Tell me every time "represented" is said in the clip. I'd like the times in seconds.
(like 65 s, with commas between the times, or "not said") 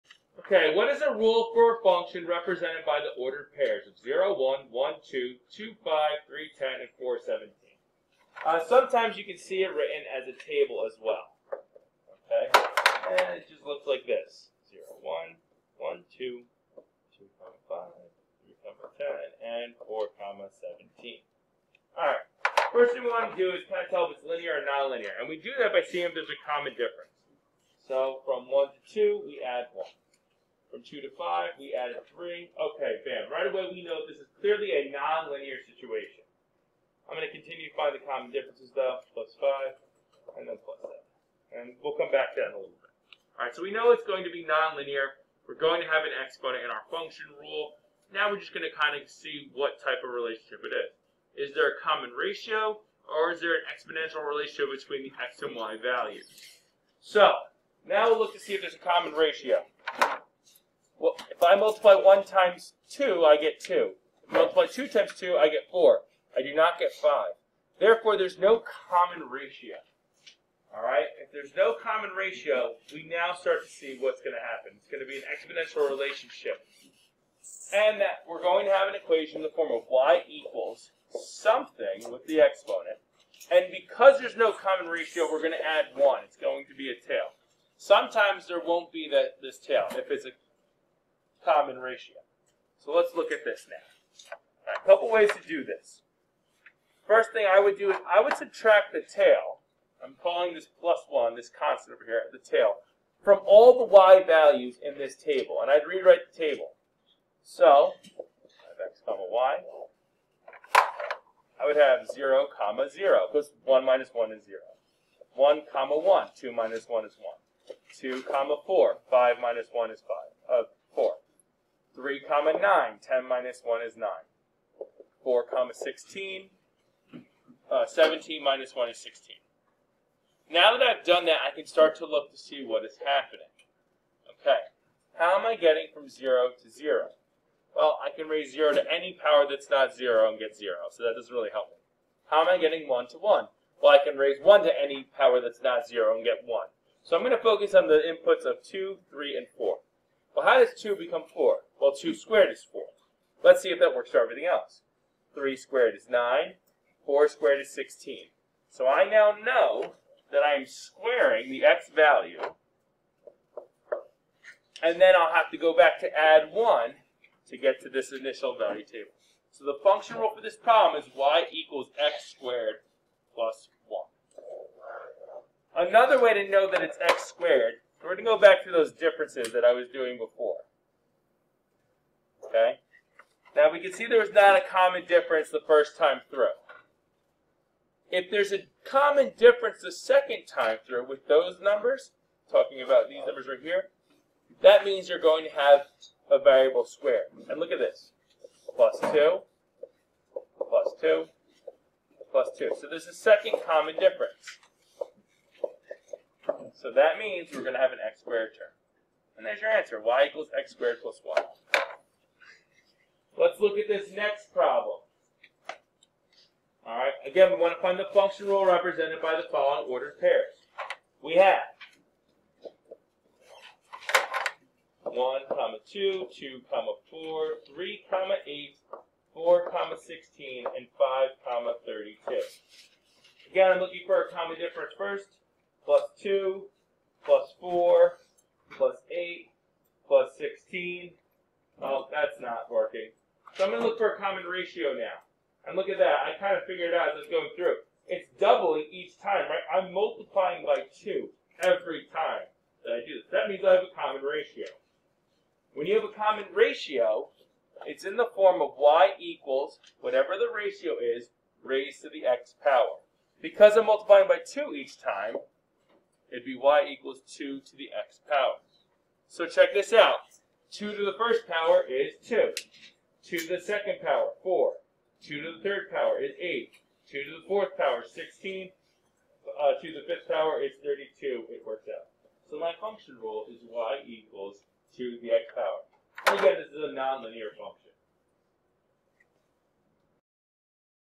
2 s, 218 s.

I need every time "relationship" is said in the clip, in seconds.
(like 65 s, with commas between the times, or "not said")
50 s, 54 s, 75 s.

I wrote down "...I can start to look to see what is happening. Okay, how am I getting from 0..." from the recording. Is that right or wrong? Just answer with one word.
right.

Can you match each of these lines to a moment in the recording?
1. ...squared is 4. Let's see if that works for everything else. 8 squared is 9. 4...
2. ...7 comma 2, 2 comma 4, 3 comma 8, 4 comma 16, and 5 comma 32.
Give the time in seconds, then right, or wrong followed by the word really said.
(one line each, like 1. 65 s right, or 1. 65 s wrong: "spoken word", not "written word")
1. 152 s wrong: "3", not "8"
2. 225 s wrong: "1", not "7".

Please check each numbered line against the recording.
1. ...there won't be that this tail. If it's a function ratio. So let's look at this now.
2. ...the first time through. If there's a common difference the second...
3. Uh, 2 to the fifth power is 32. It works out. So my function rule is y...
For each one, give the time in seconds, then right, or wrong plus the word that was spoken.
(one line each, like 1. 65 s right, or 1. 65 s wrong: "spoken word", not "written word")
1. 88 s wrong: "common", not "function"
2. 185 s right
3. 279 s right.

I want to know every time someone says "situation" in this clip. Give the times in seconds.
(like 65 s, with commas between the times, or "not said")
35 s.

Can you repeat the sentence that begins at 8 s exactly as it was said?
Uh, sometimes you can see it written as a table as well.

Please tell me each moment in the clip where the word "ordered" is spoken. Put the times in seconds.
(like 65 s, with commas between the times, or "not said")
3 s, 219 s.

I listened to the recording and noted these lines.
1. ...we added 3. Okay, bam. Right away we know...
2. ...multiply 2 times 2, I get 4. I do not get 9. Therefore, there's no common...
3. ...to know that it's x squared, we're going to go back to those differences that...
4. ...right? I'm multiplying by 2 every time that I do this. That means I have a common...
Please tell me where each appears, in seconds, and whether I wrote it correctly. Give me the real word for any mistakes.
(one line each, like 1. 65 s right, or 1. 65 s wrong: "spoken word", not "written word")
1. 31 s right
2. 64 s wrong: "5", not "9"
3. 176 s right
4. 249 s right.